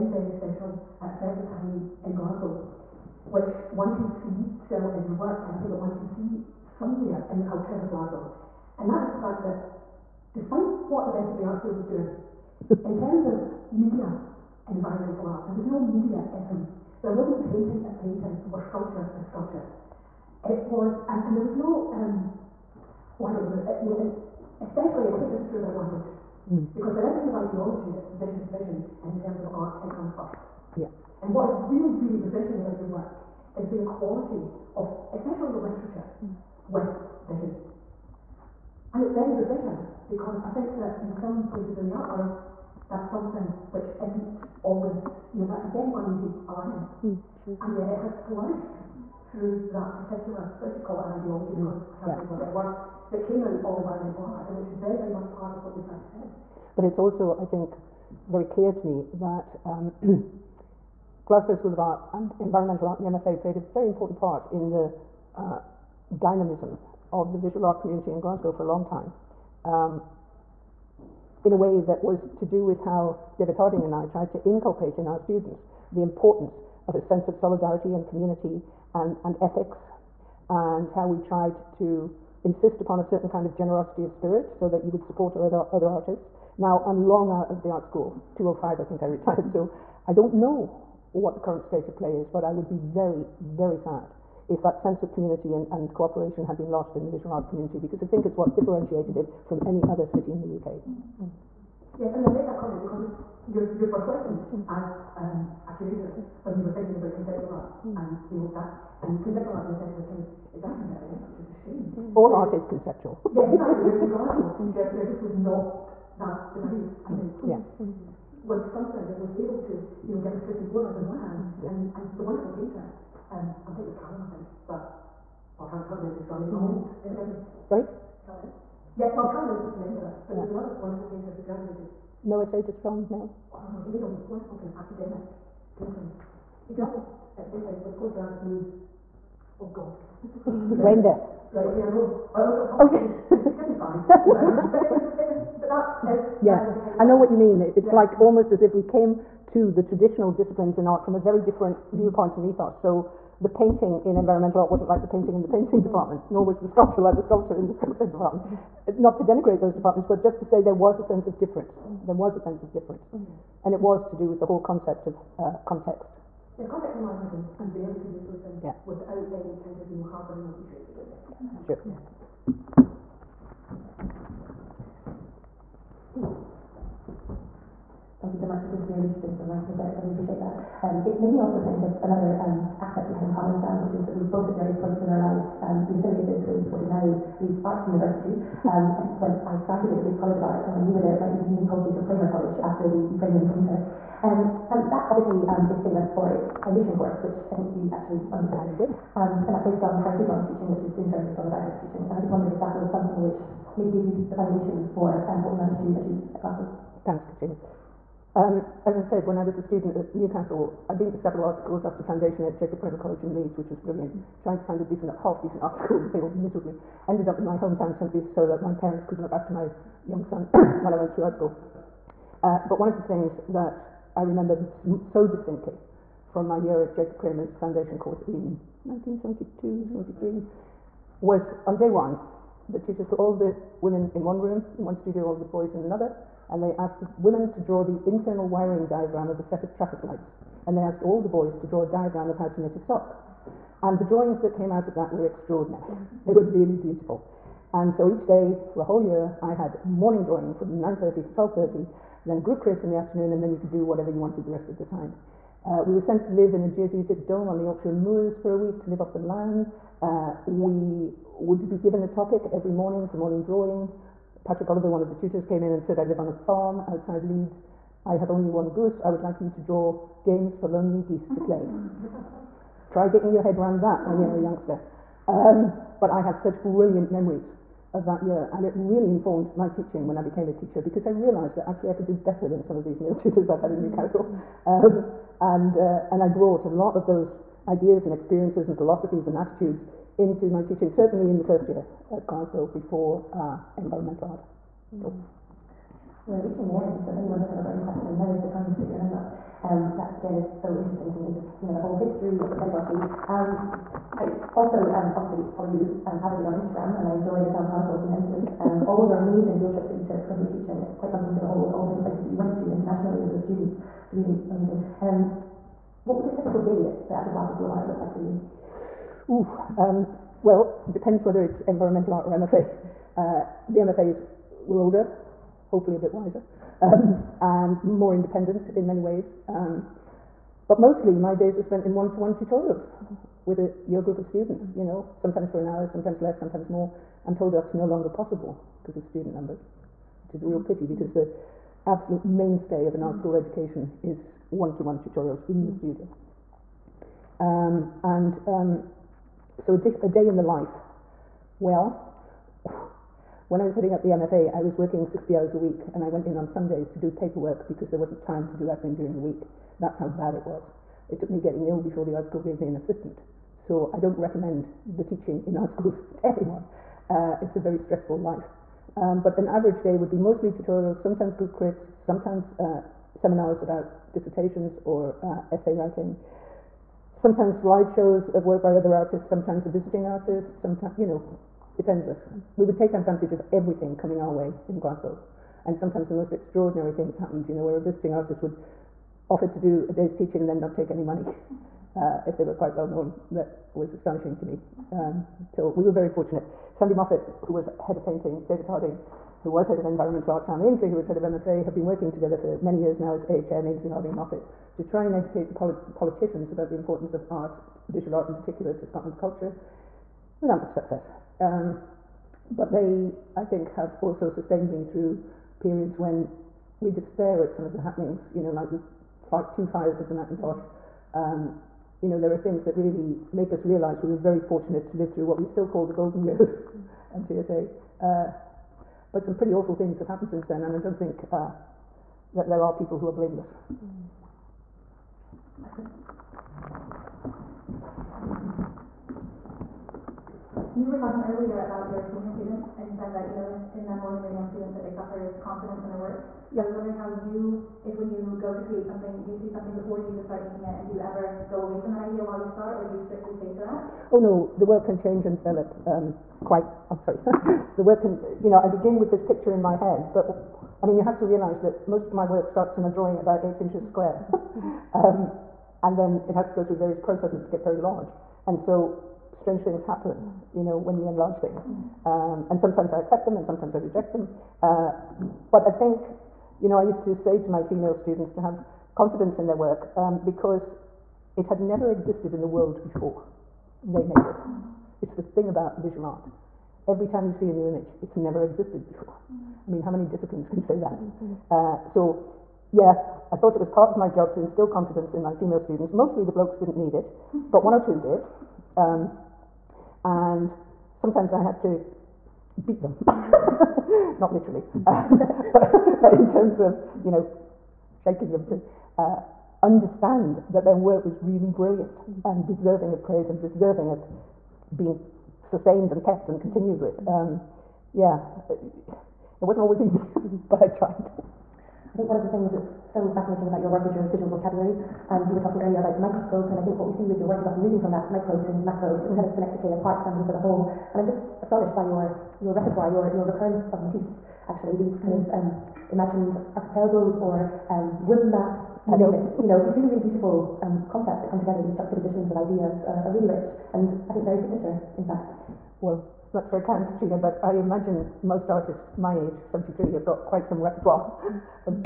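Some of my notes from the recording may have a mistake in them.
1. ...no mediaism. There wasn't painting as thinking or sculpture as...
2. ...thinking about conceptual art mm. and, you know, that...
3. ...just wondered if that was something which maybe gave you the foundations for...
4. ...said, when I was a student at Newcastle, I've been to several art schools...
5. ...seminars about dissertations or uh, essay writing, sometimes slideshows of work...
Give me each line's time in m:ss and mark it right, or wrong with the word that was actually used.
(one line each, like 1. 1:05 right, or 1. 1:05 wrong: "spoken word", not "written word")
1. 0:15 wrong: "painting", not "thinking"
2. 1:46 right
3. 3:22 right
4. 3:29 right
5. 6:13 right.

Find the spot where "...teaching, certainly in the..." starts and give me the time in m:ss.
4:50.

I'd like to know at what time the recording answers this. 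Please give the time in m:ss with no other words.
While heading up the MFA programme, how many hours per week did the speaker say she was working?
5:55.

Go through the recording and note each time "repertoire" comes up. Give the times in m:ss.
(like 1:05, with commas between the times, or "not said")
8:52, 9:10.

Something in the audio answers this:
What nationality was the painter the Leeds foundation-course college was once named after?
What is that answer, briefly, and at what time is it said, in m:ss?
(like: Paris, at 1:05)
Ukrainian, at 3:12.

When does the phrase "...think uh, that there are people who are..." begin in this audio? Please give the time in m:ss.
7:10.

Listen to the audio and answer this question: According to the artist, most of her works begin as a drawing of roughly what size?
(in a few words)
eight inches square.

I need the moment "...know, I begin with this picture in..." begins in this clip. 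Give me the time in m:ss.
7:38.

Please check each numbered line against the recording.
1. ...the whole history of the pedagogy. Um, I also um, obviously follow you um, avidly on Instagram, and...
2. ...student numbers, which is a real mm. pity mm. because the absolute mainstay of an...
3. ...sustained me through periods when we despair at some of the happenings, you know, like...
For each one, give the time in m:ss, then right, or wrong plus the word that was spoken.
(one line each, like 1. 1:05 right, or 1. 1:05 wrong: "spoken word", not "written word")
1. 5:01 right
2. 5:39 right
3. 6:54 right.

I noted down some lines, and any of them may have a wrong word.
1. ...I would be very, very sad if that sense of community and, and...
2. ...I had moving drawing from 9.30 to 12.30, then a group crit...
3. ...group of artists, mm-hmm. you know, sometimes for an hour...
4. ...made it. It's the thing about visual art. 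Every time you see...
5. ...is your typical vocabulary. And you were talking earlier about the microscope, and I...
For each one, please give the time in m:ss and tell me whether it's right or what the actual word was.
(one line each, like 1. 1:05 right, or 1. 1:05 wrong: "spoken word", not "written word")
1. 1:32 right
2. 4:09 wrong: "morning", not "moving"
3. 5:34 wrong: "students", not "artists"
4. 8:04 right
5. 8:43 wrong: "visual", not "typical".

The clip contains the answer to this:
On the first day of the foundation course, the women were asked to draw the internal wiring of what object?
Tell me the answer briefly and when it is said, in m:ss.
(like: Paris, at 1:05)
traffic lights, at 3:59.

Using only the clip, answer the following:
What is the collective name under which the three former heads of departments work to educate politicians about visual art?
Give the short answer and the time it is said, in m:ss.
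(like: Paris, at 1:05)
AHM, at 6:43.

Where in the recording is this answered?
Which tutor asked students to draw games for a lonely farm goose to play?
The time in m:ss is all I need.
4:24.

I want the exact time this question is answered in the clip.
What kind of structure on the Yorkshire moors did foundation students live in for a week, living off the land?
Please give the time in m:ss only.
4:16.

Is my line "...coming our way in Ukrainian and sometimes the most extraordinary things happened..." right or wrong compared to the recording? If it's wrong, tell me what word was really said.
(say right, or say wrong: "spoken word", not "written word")
wrong: "Glasgow", not "Ukrainian".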